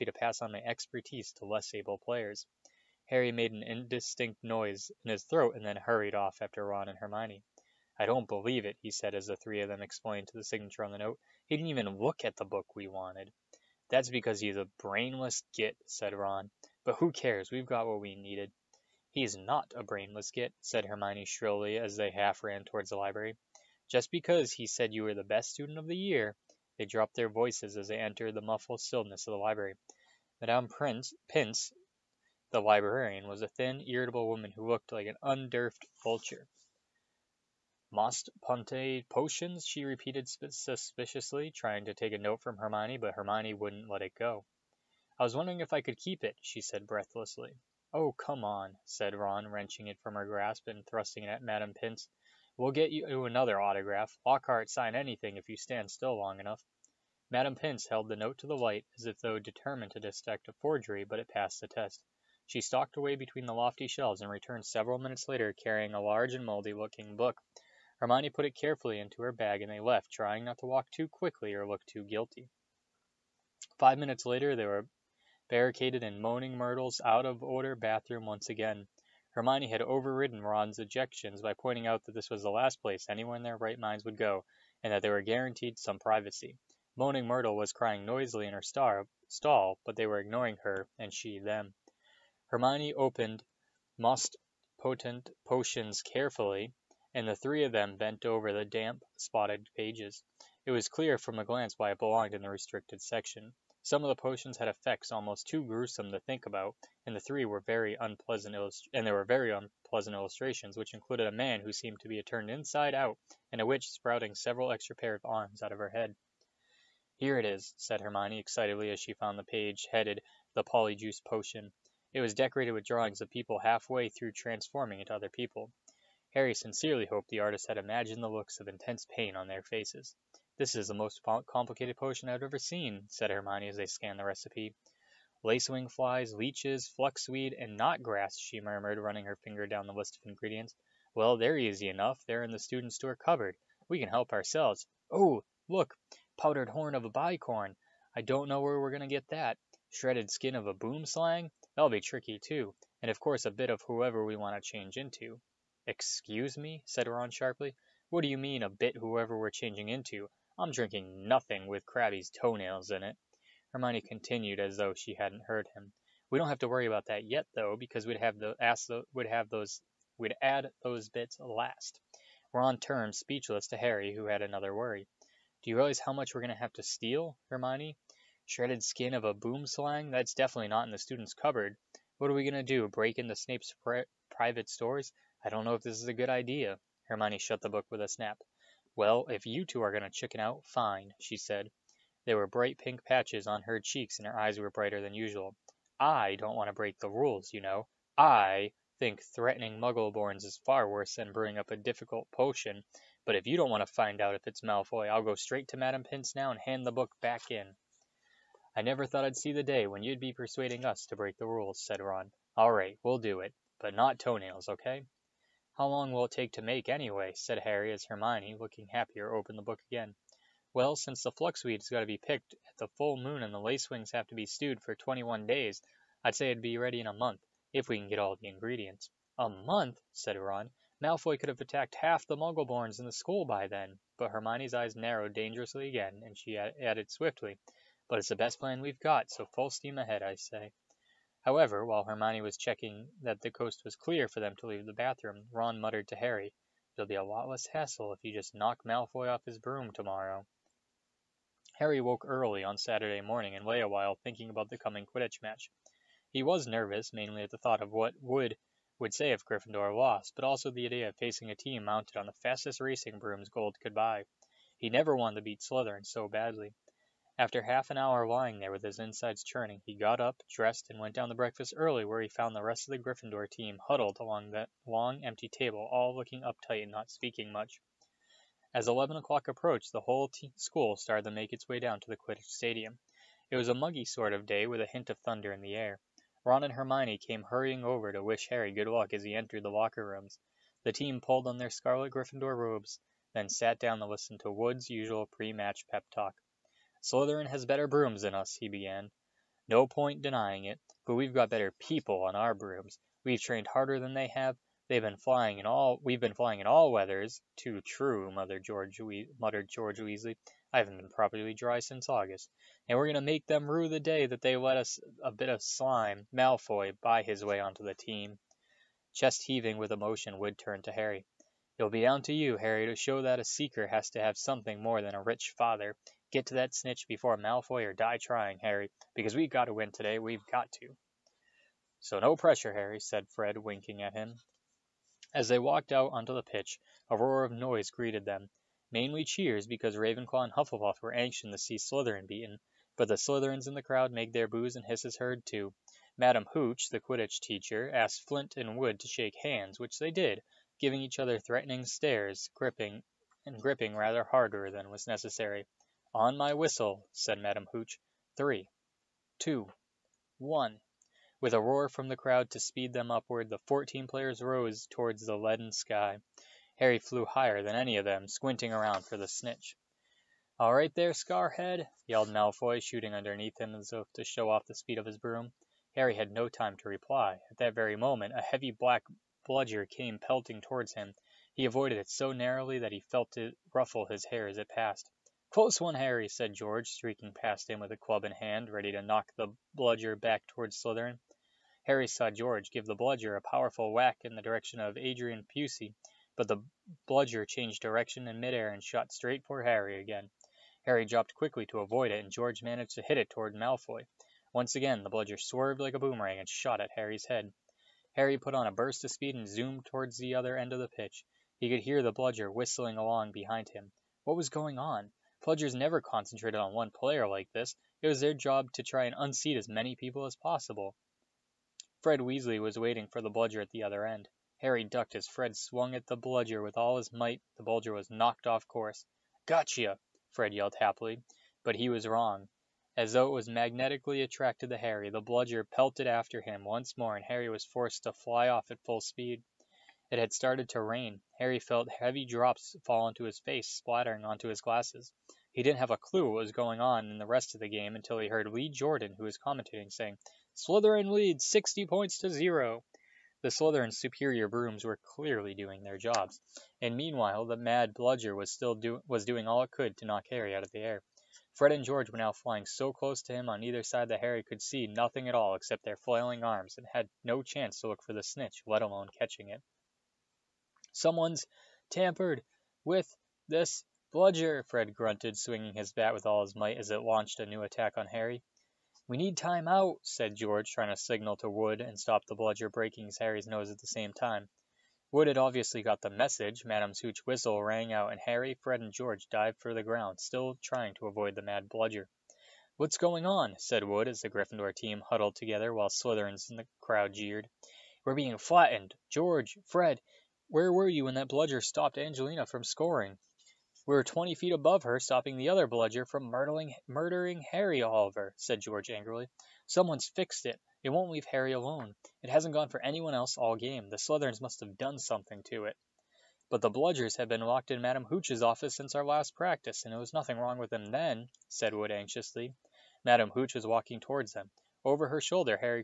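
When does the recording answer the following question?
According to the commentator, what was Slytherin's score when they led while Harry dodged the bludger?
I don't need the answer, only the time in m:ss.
7:31.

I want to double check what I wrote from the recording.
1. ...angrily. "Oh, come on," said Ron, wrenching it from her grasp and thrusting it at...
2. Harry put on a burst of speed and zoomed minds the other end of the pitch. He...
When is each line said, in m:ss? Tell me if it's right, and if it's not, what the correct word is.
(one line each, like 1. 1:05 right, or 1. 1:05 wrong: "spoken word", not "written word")
1. 0:46 wrong: "breathlessly", not "angrily"
2. 6:48 wrong: "towards", not "minds".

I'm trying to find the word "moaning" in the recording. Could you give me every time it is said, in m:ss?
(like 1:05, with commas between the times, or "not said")
1:16, 1:26.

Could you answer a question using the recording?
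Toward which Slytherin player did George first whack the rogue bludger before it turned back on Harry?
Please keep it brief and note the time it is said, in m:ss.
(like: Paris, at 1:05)
Adrian Pusey, at 6:34.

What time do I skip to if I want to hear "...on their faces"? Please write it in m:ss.
2:09.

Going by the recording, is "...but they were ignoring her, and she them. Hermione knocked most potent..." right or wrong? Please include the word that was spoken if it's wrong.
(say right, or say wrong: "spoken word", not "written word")
wrong: "opened", not "knocked".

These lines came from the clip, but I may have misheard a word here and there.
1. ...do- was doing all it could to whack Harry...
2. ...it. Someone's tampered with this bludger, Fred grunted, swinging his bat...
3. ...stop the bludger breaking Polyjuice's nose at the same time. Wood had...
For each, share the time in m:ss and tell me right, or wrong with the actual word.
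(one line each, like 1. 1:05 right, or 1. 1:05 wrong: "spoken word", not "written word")
1. 7:38 wrong: "knock", not "whack"
2. 7:49 right
3. 8:01 wrong: "Harry", not "Polyjuice".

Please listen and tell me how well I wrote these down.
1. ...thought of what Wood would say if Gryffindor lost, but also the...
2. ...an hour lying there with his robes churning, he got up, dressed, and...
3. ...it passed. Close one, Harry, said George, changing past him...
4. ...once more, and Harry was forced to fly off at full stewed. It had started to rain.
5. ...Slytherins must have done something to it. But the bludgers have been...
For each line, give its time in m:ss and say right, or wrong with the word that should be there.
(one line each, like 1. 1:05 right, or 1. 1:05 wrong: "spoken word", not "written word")
1. 4:17 right
2. 4:27 wrong: "insides", not "robes"
3. 6:24 wrong: "streaking", not "changing"
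4. 7:16 wrong: "speed", not "stewed"
5. 8:33 right.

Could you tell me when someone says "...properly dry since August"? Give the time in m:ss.
5:11.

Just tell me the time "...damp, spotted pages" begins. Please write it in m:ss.
1:38.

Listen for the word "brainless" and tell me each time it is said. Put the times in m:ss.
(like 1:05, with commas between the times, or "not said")
0:14, 0:19.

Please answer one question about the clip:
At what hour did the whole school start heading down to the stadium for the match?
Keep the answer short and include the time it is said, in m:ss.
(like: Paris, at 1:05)
11 o'clock, at 4:38.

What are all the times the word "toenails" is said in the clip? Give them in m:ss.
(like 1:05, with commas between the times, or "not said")
2:42, 3:34.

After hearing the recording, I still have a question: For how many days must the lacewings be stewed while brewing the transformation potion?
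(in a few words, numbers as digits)
21.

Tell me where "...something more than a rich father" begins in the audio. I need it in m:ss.
5:24.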